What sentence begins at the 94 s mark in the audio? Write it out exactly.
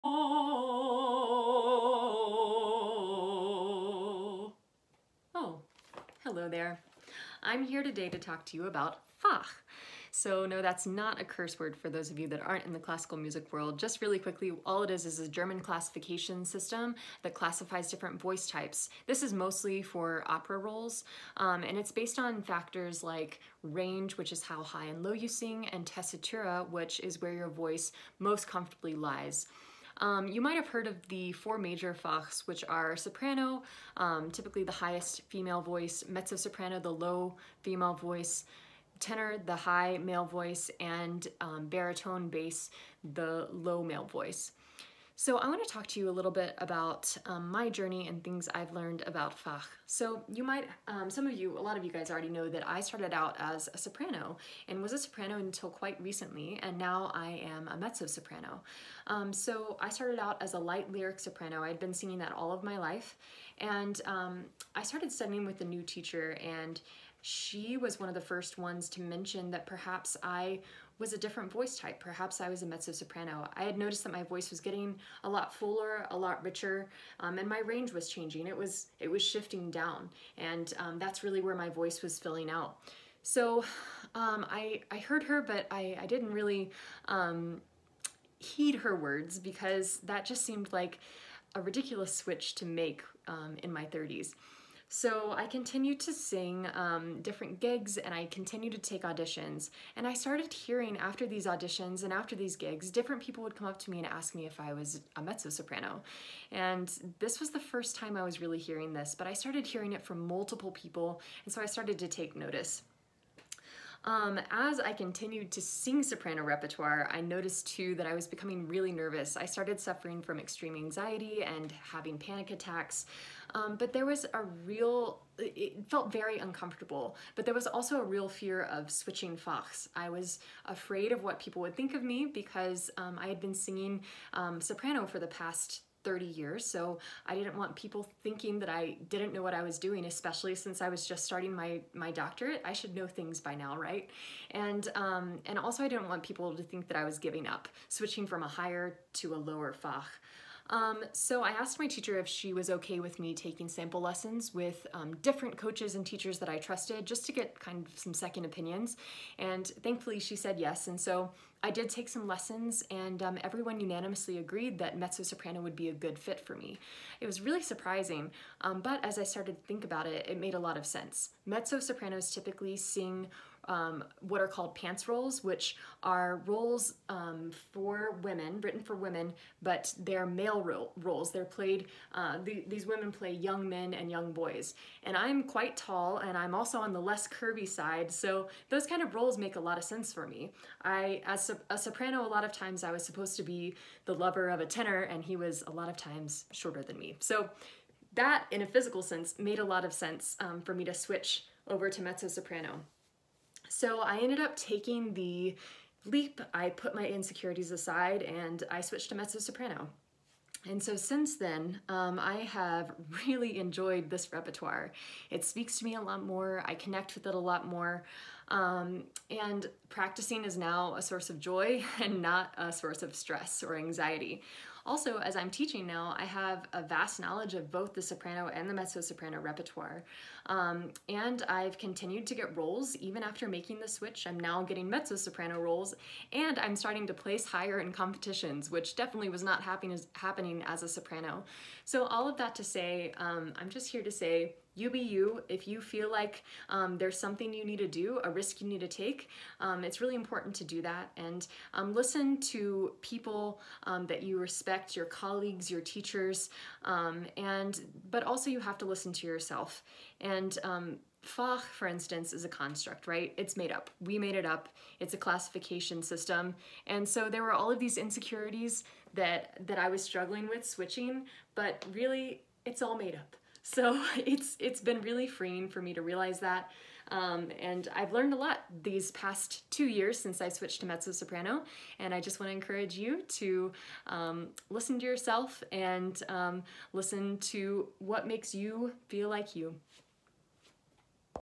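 So I continued to sing um, different gigs and I continued to take auditions.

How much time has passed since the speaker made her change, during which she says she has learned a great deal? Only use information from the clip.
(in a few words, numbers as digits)
2 years.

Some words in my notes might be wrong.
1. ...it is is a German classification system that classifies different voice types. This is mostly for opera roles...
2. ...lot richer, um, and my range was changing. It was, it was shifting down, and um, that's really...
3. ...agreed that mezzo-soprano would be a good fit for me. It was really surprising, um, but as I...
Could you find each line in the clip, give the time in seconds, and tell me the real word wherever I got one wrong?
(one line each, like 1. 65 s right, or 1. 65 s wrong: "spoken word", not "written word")
1. 14 s right
2. 76 s right
3. 164 s right.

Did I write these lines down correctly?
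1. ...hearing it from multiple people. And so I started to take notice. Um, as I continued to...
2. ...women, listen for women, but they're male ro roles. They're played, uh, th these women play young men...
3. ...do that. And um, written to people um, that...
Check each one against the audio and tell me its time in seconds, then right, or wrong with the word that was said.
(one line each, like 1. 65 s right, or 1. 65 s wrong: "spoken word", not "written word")
1. 109 s right
2. 178 s wrong: "written", not "listen"
3. 250 s wrong: "listen", not "written".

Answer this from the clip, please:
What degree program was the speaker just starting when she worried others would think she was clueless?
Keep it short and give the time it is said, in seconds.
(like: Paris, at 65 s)
doctorate, at 142 s.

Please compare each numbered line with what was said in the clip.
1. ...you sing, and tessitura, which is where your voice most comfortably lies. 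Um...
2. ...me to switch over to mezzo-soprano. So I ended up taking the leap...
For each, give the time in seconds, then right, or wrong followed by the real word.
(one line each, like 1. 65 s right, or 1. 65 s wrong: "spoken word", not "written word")
1. 25 s right
2. 200 s right.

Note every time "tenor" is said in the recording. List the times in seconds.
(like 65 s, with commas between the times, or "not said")
38 s, 194 s.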